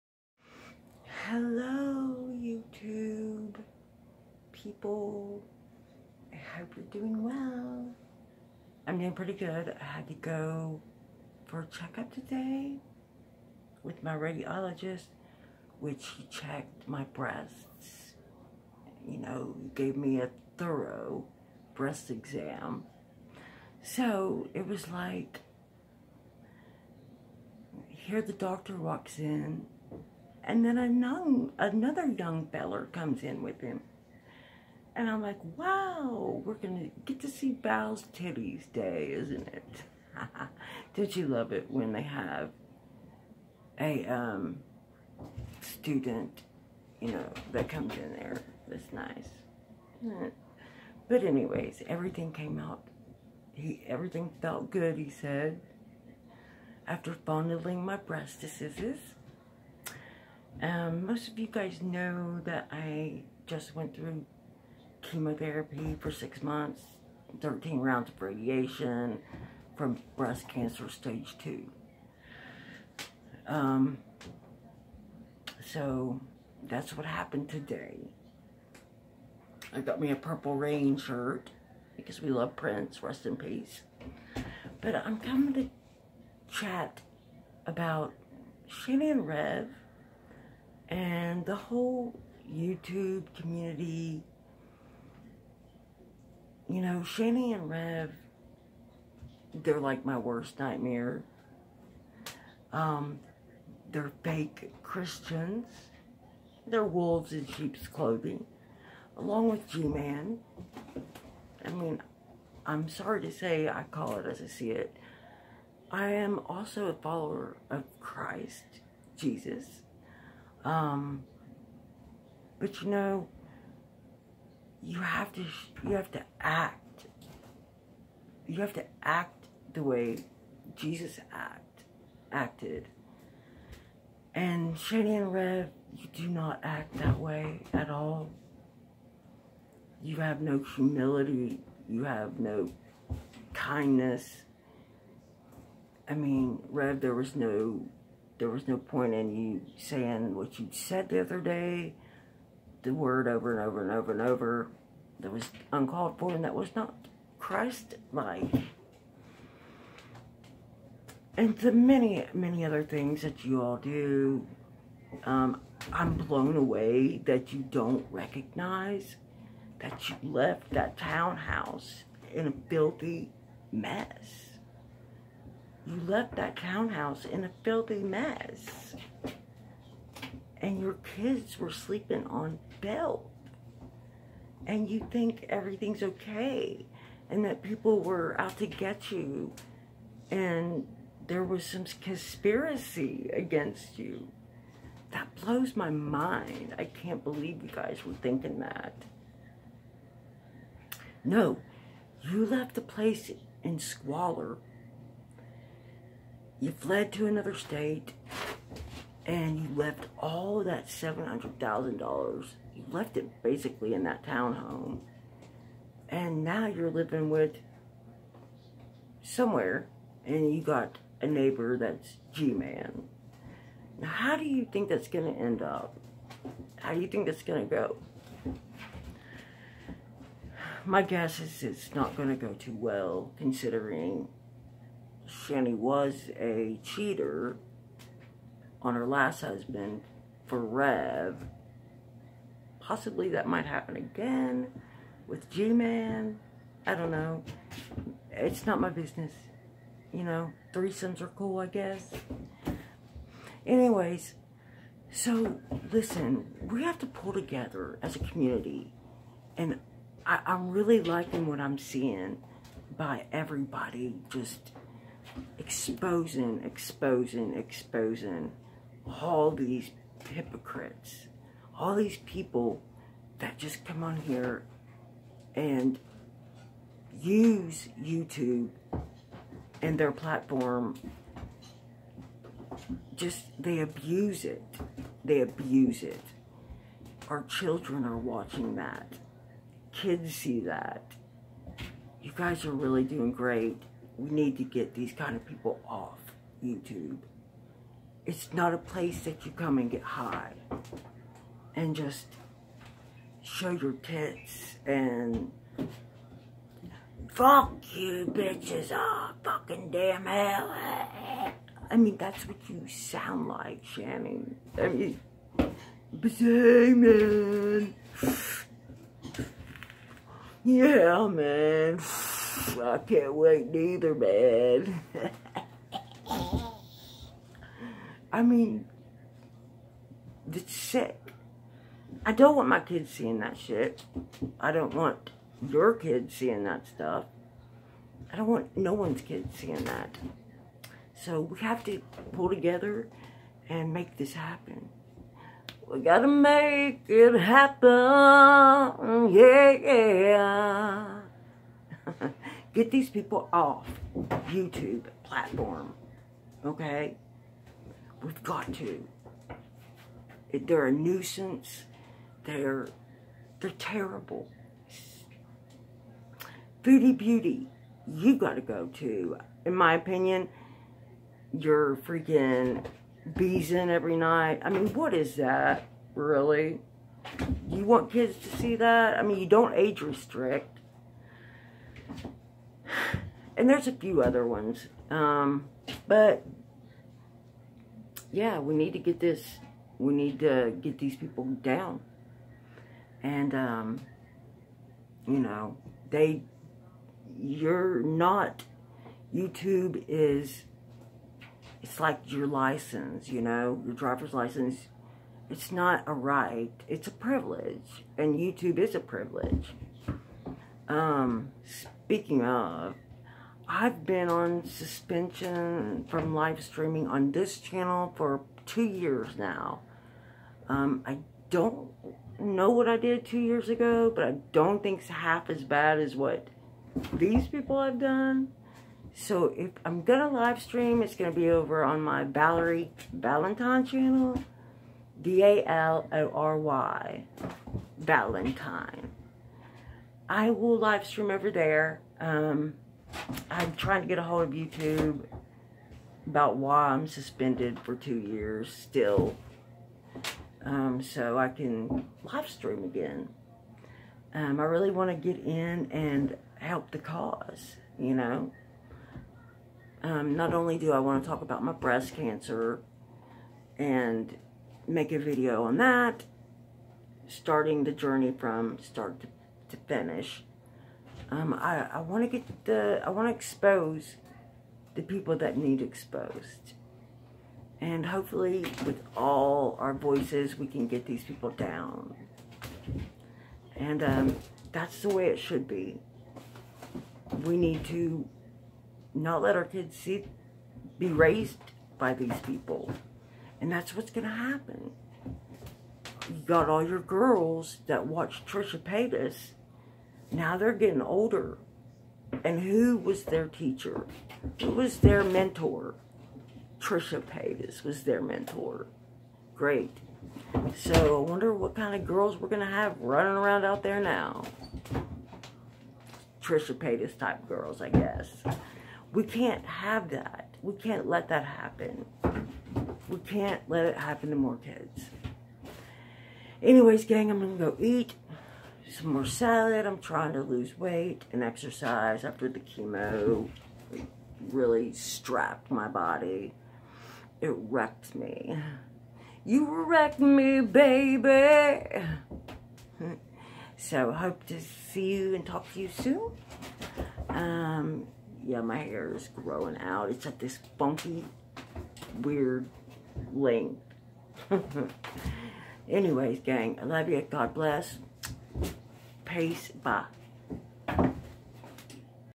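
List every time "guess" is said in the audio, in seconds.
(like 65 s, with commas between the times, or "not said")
231 s, 251 s, 517 s.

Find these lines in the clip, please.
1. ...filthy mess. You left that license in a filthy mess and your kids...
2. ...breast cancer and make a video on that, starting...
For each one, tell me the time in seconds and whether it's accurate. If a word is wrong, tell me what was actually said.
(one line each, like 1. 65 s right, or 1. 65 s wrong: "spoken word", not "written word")
1. 172 s wrong: "townhouse", not "license"
2. 461 s right.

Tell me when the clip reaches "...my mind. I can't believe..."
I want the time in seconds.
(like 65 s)
195 s.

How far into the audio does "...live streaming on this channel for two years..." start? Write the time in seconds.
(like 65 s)
416 s.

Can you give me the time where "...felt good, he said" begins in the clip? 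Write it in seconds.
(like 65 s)
54 s.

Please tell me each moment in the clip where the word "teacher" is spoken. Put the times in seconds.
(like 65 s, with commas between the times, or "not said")
503 s.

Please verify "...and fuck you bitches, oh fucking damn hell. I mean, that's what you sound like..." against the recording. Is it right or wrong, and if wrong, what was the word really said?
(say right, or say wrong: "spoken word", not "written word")
right.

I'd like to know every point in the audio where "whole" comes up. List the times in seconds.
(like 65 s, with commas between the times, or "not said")
91 s.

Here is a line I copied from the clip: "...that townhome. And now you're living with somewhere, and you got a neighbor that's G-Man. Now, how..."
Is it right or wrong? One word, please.
right.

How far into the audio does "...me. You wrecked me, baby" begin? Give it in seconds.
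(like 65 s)
538 s.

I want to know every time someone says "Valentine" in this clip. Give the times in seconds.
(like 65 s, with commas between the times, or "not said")
433 s, 437 s.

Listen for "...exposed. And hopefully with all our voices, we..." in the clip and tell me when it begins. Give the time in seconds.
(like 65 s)
475 s.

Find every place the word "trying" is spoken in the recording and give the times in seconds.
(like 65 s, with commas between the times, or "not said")
443 s, 529 s.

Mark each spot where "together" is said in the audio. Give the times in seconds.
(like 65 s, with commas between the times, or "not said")
257 s, 342 s.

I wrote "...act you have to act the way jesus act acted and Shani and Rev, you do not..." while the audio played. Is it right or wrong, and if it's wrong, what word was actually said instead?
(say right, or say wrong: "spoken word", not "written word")
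right.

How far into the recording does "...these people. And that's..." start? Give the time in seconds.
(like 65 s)
492 s.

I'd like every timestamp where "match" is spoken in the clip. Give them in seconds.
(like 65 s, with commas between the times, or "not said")
not said.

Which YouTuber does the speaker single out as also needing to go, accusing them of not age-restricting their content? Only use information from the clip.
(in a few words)
Foodie Beauty.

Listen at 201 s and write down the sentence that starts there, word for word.
No, you left the place in squalor.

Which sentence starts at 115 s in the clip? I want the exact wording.
I am also a follower of Christ, Jesus.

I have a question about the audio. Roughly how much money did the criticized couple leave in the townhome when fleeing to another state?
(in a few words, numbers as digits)
$700,000.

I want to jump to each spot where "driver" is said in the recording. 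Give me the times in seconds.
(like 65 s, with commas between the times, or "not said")
403 s.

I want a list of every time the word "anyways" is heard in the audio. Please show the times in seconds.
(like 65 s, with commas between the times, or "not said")
51 s, 253 s, 526 s, 555 s.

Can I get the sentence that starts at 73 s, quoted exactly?
Um, so that's what happened today.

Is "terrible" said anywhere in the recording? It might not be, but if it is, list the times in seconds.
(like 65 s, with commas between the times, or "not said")
363 s.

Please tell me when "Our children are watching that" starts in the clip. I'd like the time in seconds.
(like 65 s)
287 s.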